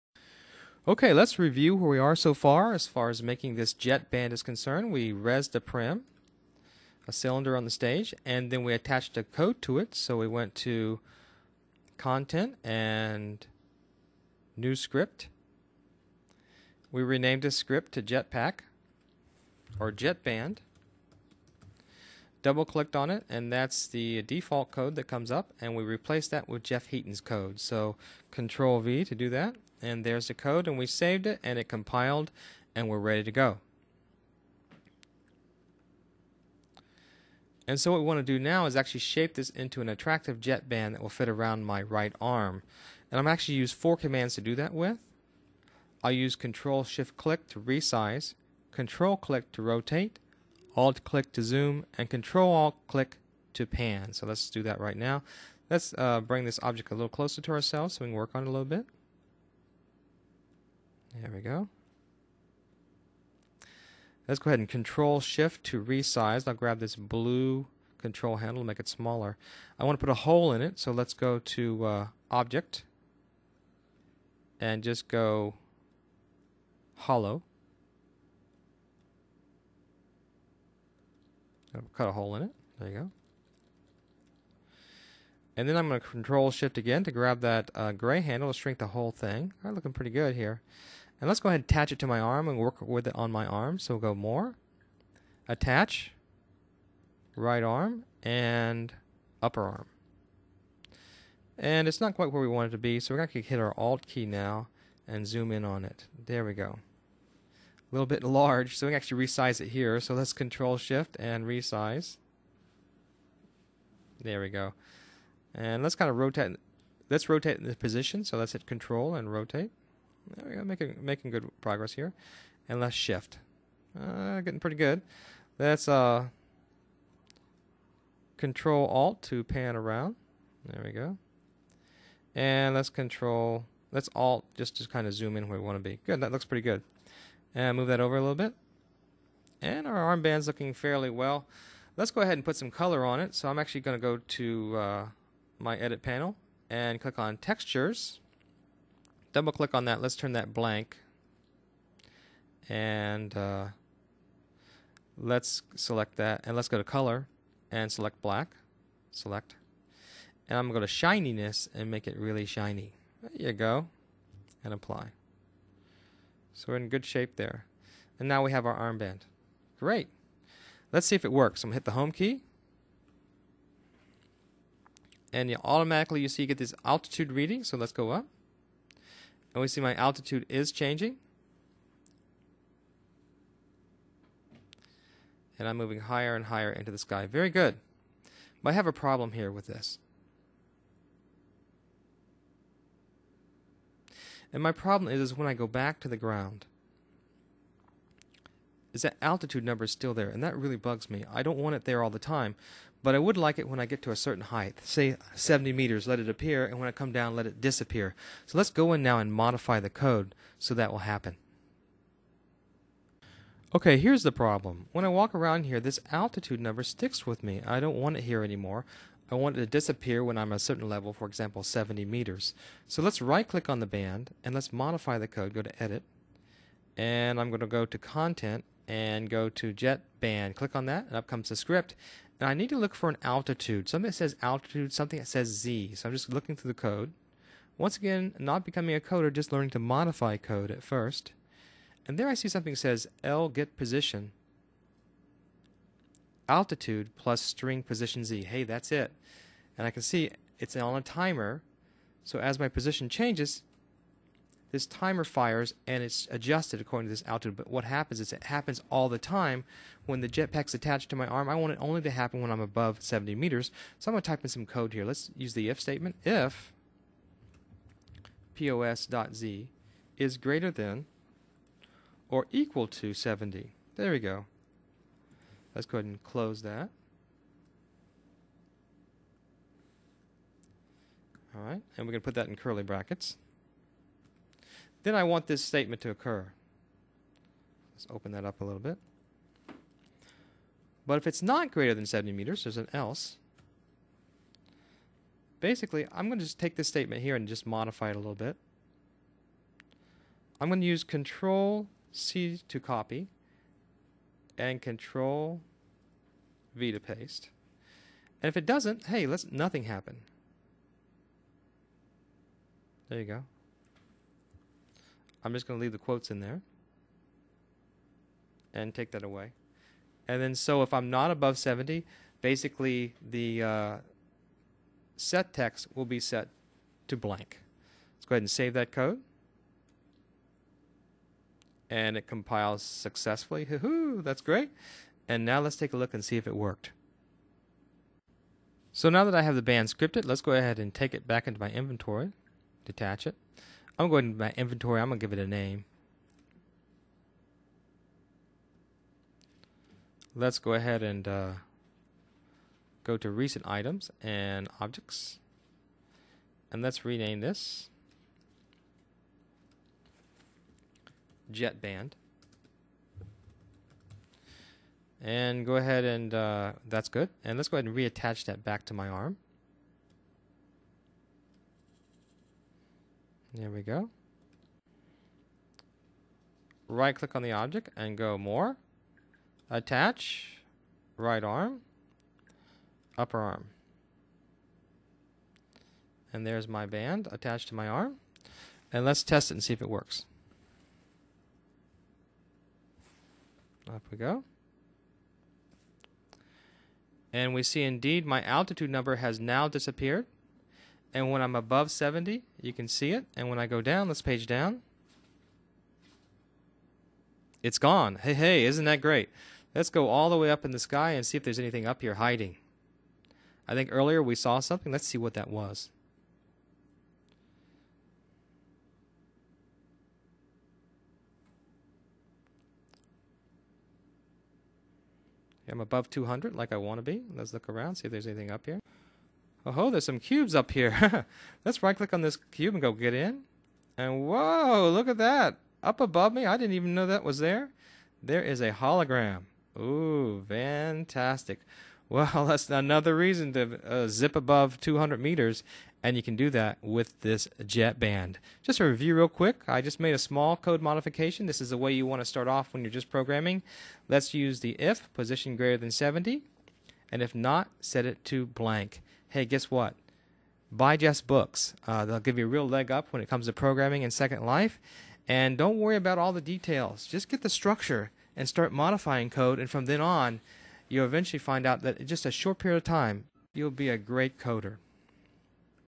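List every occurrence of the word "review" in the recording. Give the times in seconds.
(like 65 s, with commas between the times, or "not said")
1 s, 448 s.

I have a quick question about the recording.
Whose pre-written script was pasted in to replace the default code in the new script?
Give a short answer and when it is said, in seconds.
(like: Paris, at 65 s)
Jeff Heaton, at 26 s.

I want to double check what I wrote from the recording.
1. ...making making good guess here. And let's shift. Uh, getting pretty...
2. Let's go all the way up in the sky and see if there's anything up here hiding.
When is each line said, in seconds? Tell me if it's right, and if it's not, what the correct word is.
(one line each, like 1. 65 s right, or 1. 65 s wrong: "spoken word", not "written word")
1. 120 s wrong: "progress", not "guess"
2. 409 s right.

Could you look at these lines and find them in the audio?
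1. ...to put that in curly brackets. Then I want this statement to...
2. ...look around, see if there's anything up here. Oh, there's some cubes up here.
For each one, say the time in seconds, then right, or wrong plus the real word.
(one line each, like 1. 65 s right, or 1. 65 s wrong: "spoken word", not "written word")
1. 282 s right
2. 427 s right.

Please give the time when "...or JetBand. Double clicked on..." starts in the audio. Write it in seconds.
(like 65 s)
19 s.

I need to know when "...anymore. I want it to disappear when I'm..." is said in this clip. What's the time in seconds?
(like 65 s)
218 s.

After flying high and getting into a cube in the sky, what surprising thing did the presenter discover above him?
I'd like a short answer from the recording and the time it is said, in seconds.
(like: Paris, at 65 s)
A hologram, at 438 s.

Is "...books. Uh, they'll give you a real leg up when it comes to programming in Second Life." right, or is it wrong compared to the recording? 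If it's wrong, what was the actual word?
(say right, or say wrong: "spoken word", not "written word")
right.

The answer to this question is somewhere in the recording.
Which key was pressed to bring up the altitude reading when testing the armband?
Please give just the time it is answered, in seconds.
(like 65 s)
171 s.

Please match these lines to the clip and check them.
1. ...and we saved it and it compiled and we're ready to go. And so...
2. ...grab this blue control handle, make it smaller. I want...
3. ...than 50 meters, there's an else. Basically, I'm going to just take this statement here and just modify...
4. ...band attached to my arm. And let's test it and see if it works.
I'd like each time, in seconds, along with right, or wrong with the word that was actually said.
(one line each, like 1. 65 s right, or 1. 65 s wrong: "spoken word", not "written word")
1. 30 s right
2. 66 s right
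3. 291 s wrong: "70", not "50"
4. 386 s right.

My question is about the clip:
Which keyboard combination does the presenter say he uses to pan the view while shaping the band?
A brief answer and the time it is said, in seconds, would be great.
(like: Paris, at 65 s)
Control Alt click, at 52 s.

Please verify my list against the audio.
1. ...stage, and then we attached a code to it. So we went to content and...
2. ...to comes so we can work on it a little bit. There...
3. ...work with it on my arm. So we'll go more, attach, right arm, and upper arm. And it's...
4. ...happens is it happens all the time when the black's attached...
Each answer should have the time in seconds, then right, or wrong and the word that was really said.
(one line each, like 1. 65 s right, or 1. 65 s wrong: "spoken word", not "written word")
1. 7 s right
2. 57 s wrong: "ourselves", not "comes"
3. 92 s right
4. 257 s wrong: "jetpack", not "black".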